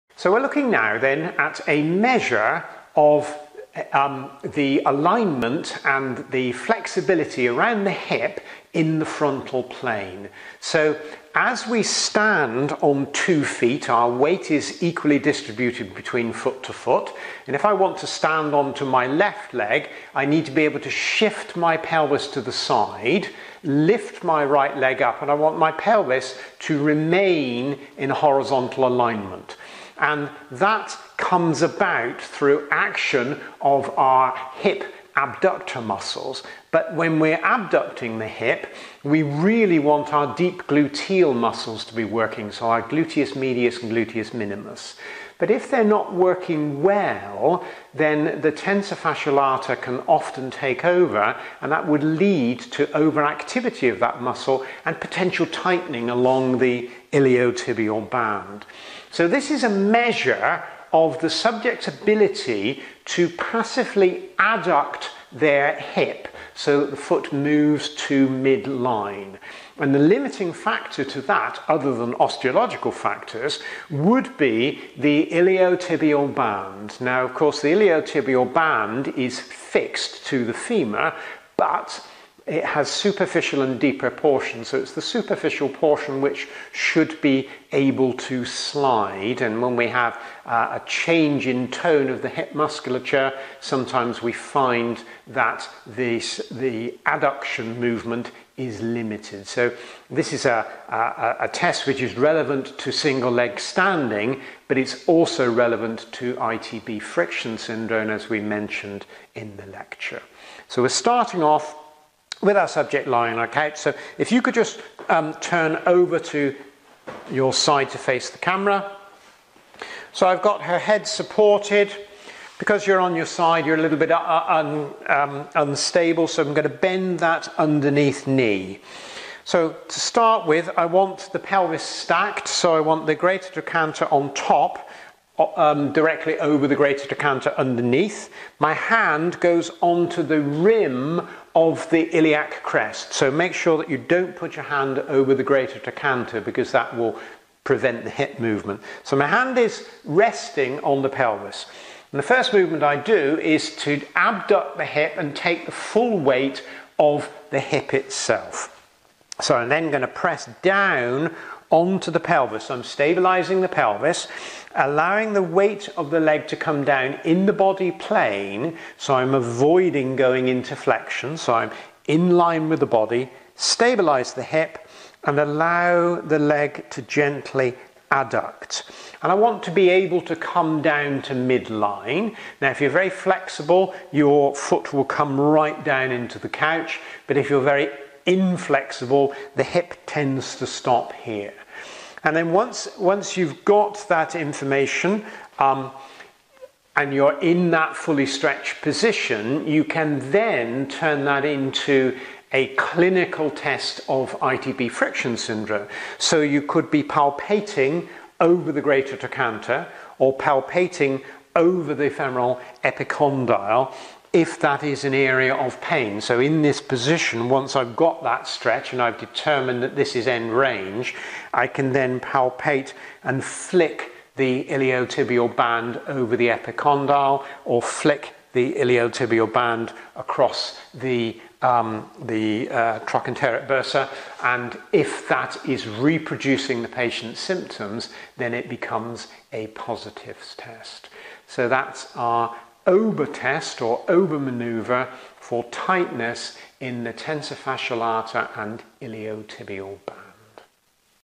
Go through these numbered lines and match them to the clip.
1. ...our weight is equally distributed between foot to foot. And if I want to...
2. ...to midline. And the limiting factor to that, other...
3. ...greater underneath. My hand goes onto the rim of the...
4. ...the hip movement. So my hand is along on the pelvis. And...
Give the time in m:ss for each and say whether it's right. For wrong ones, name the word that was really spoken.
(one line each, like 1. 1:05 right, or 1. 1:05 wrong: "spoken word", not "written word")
1. 0:13 right
2. 1:07 right
3. 2:17 wrong: "trochanter", not "greater"
4. 2:28 wrong: "resting", not "along".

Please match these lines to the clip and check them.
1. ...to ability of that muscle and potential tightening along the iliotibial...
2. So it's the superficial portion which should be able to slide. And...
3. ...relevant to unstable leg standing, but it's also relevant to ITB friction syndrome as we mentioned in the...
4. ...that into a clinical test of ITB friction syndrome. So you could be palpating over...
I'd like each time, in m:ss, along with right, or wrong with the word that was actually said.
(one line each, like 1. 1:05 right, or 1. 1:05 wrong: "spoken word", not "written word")
1. 0:52 wrong: "overactivity", not "ability"
2. 1:24 right
3. 1:42 wrong: "single", not "unstable"
4. 3:21 right.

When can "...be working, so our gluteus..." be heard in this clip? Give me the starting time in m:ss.
0:41.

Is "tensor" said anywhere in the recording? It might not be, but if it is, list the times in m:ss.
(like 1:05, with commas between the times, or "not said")
0:48, 4:07.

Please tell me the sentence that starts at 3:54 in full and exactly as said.
And if that is reproducing the patient's symptoms, then it becomes a positives test.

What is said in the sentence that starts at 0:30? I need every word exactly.
And that comes about through action of our hip abductor muscles.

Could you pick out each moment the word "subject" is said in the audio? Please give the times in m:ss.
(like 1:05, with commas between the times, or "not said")
1:01, 1:52.